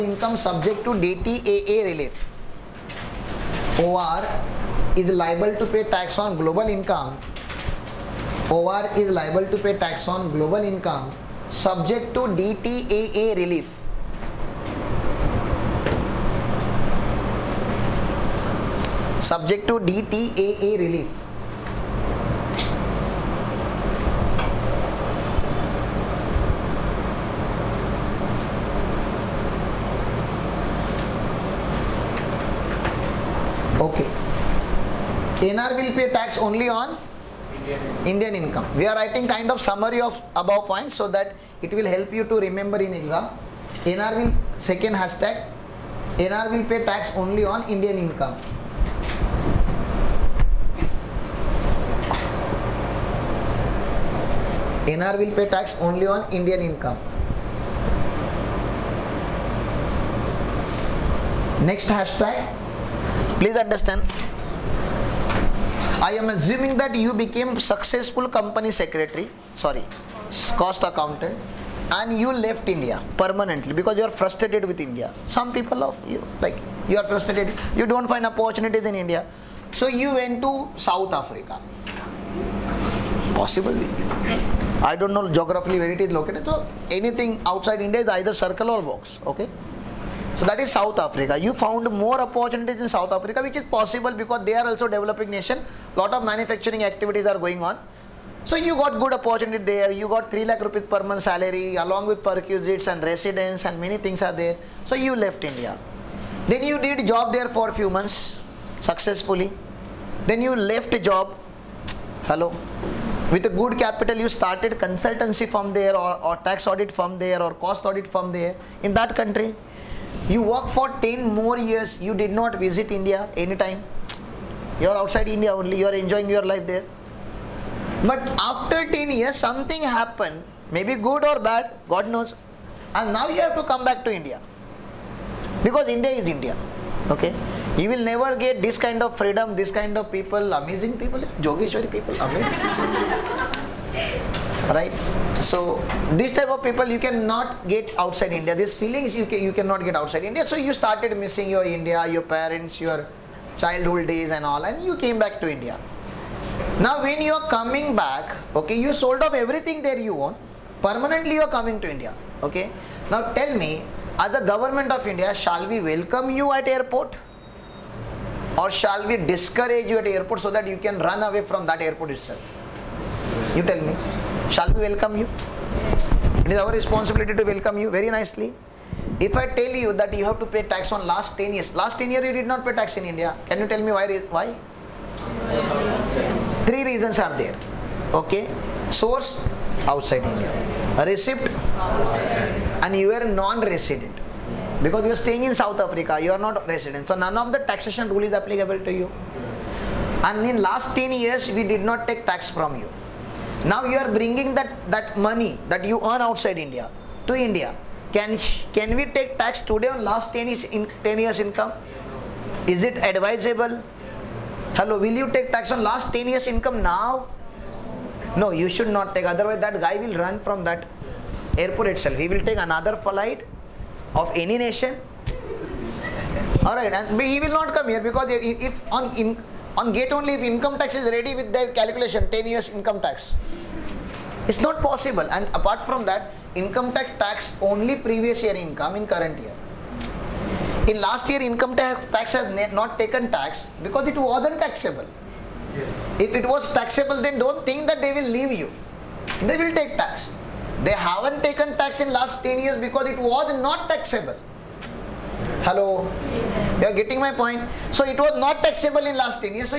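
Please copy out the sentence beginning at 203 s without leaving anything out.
Now you are bringing that, that money that you earn outside India to India.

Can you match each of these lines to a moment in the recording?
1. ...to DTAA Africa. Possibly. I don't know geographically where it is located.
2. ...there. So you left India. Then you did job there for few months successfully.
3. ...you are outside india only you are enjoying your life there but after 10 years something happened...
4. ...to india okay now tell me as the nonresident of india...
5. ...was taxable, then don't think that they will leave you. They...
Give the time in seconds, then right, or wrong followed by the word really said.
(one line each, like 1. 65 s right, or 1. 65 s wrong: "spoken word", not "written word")
1. 80 s wrong: "South", not "DTAA"
2. 104 s right
3. 124 s right
4. 161 s wrong: "government", not "nonresident"
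5. 246 s right.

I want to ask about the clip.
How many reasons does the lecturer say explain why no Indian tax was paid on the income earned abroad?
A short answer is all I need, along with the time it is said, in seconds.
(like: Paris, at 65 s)
3, at 186 s.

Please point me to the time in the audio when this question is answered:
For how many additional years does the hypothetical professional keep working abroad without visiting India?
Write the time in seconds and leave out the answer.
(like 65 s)
121 s.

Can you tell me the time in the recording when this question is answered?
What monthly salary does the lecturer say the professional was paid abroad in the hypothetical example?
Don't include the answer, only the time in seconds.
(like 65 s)
100 s.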